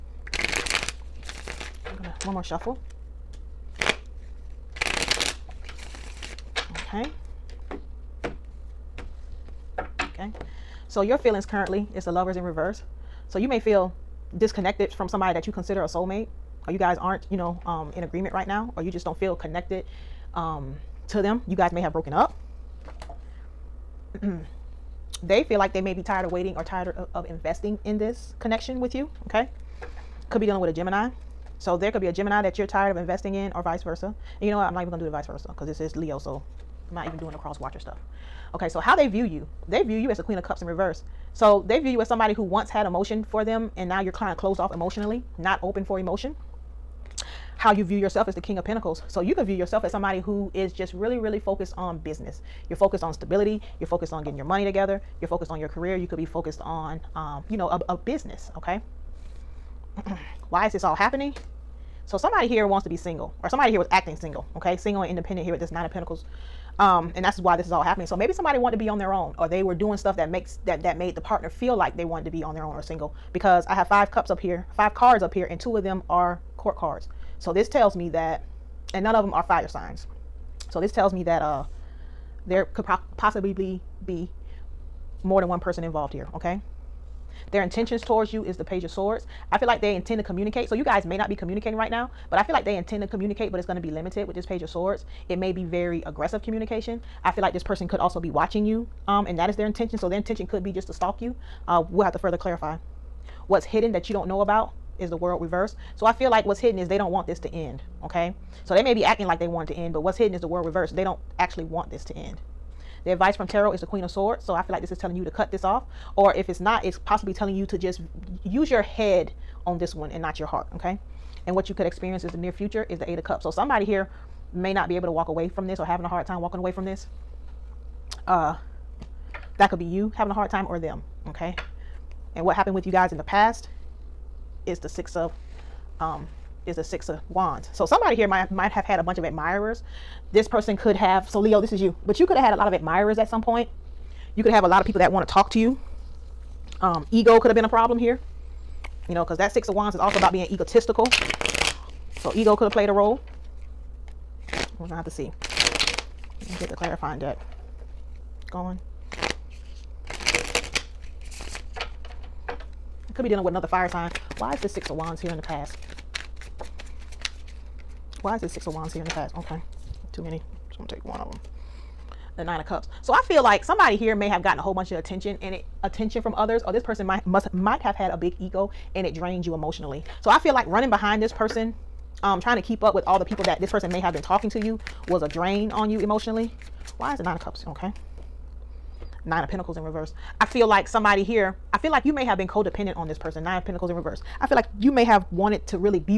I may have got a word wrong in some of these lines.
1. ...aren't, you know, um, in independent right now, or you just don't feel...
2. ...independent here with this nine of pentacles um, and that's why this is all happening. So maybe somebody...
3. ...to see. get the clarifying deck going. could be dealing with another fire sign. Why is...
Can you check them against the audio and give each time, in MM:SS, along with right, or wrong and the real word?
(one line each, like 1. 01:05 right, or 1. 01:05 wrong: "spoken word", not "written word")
1. 00:16 wrong: "agreement", not "independent"
2. 01:05 right
3. 02:35 right.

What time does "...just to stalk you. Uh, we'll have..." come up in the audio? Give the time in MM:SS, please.
01:40.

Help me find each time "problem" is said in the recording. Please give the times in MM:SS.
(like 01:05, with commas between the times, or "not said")
02:27.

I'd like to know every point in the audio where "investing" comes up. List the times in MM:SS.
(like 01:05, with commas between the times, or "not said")
00:27, 00:32.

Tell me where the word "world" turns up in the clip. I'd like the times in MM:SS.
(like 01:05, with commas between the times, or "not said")
01:45, 01:50.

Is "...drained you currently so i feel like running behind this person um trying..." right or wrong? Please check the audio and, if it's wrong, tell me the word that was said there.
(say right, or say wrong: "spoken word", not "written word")
wrong: "emotionally", not "currently".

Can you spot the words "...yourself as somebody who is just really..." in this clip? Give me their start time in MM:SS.
00:49.